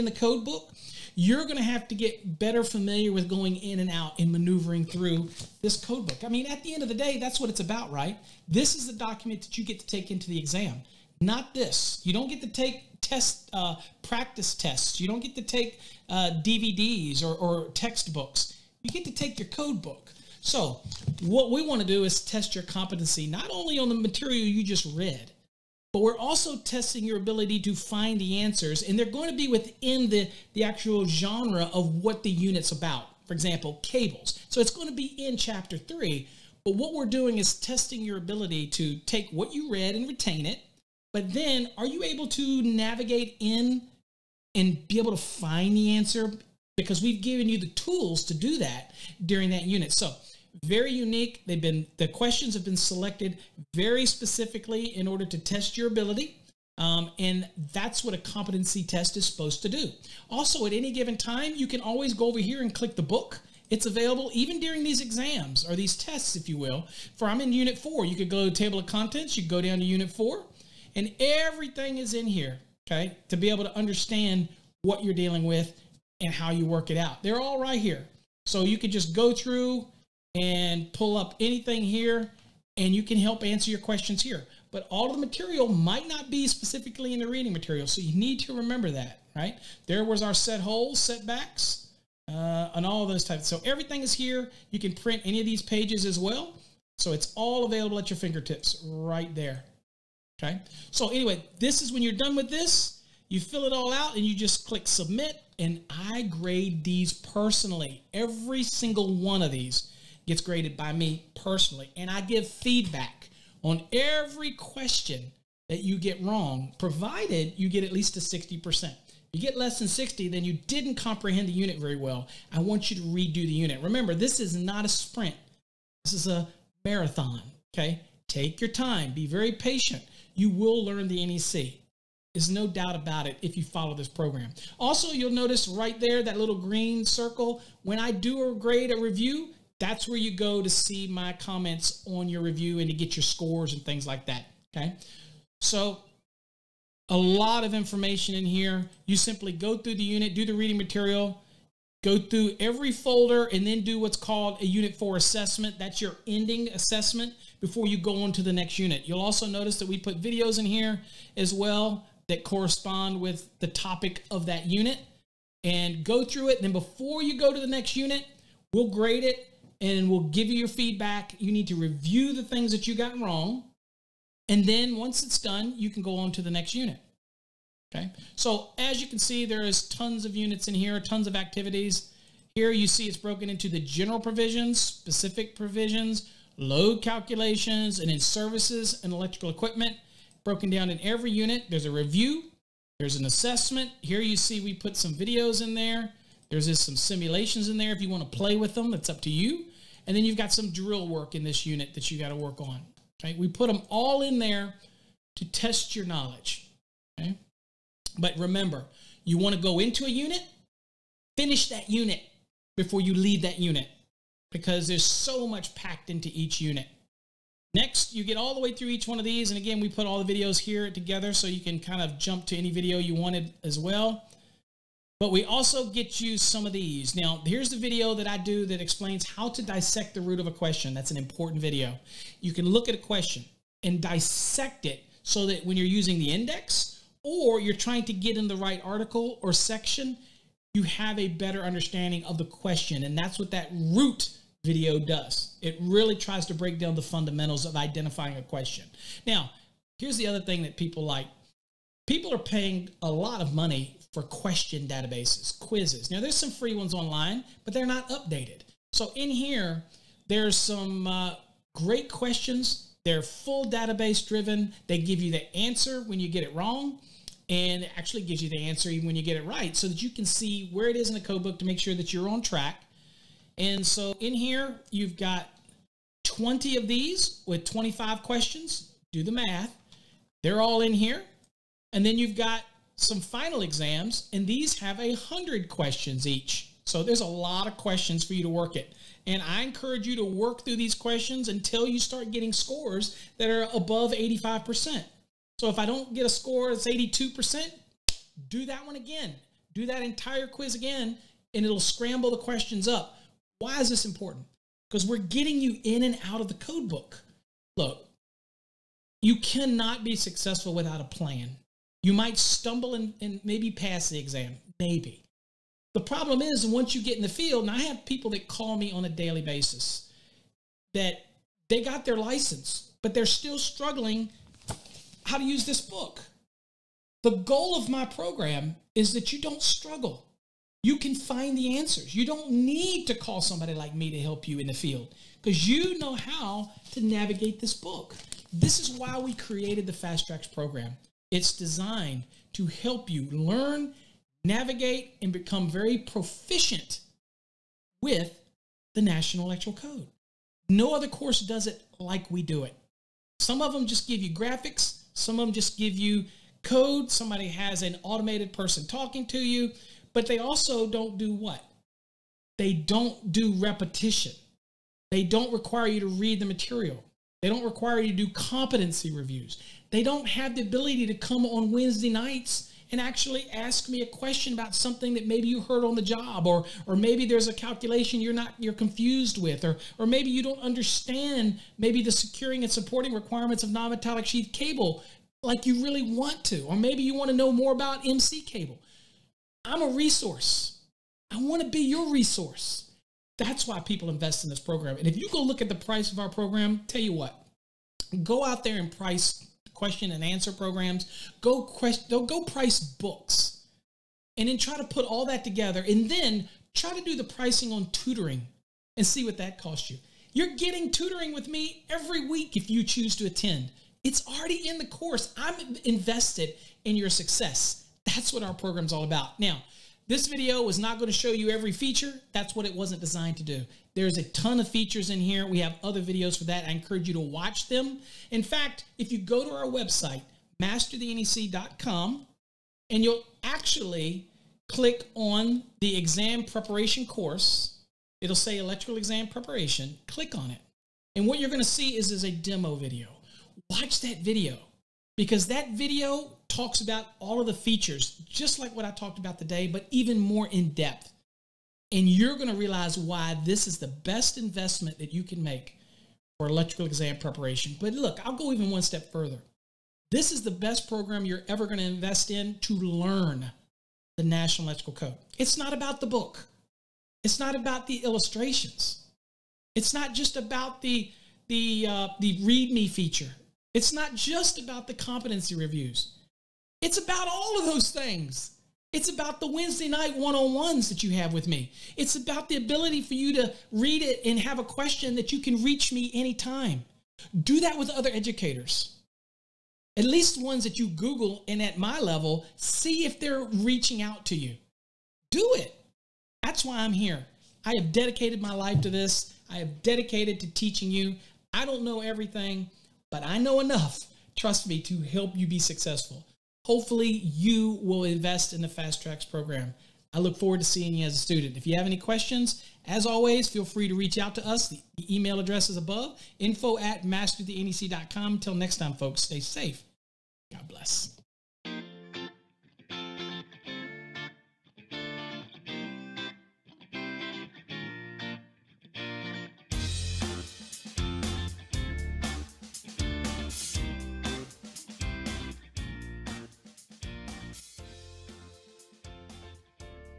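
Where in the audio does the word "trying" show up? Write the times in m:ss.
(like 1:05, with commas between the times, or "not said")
3:57.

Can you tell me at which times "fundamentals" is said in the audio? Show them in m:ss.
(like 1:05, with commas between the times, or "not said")
4:07.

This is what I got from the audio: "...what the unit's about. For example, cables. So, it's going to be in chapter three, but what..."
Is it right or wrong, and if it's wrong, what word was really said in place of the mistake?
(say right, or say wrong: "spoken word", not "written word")
right.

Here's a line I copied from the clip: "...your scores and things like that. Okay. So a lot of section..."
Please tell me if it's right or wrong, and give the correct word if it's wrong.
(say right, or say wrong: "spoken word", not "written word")
wrong: "information", not "section".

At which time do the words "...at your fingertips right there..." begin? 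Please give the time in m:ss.
1:37.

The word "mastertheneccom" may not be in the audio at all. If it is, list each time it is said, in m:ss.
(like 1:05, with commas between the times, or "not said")
7:10, 8:37.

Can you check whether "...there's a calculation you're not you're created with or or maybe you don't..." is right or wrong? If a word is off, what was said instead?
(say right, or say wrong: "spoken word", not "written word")
wrong: "confused", not "created".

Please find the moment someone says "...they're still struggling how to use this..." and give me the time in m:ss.
5:23.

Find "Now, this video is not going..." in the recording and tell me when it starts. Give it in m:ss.
6:59.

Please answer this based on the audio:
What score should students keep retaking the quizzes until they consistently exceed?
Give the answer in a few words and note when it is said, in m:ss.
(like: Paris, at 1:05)
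85%, at 4:54.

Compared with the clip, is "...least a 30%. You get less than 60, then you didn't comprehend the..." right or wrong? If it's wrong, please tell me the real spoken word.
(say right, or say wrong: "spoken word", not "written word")
wrong: "60", not "30".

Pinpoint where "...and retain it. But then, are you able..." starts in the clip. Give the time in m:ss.
0:39.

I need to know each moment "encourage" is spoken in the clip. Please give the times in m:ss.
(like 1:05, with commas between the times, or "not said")
4:49, 7:06.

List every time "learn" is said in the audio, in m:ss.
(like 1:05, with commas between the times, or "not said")
2:10, 5:43, 7:42.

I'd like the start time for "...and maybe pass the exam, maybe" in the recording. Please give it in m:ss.
5:13.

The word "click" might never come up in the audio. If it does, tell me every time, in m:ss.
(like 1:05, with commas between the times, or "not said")
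1:02, 1:44, 7:14, 7:20.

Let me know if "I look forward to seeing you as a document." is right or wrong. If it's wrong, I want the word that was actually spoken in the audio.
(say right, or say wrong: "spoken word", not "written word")
wrong: "student", not "document".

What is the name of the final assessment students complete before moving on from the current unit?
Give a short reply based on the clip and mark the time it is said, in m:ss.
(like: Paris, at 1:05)
Unit 4 assessment, at 2:34.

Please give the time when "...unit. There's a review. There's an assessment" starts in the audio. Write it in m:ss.
3:11.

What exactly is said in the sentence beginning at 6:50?
You're getting tutoring with me every week if you choose to attend.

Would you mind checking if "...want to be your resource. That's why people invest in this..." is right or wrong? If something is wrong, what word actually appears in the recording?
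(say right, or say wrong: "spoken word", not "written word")
right.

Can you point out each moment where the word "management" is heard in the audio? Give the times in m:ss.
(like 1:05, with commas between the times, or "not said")
not said.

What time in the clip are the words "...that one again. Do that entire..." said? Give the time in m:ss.
4:58.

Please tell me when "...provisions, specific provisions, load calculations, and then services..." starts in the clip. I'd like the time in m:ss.
3:04.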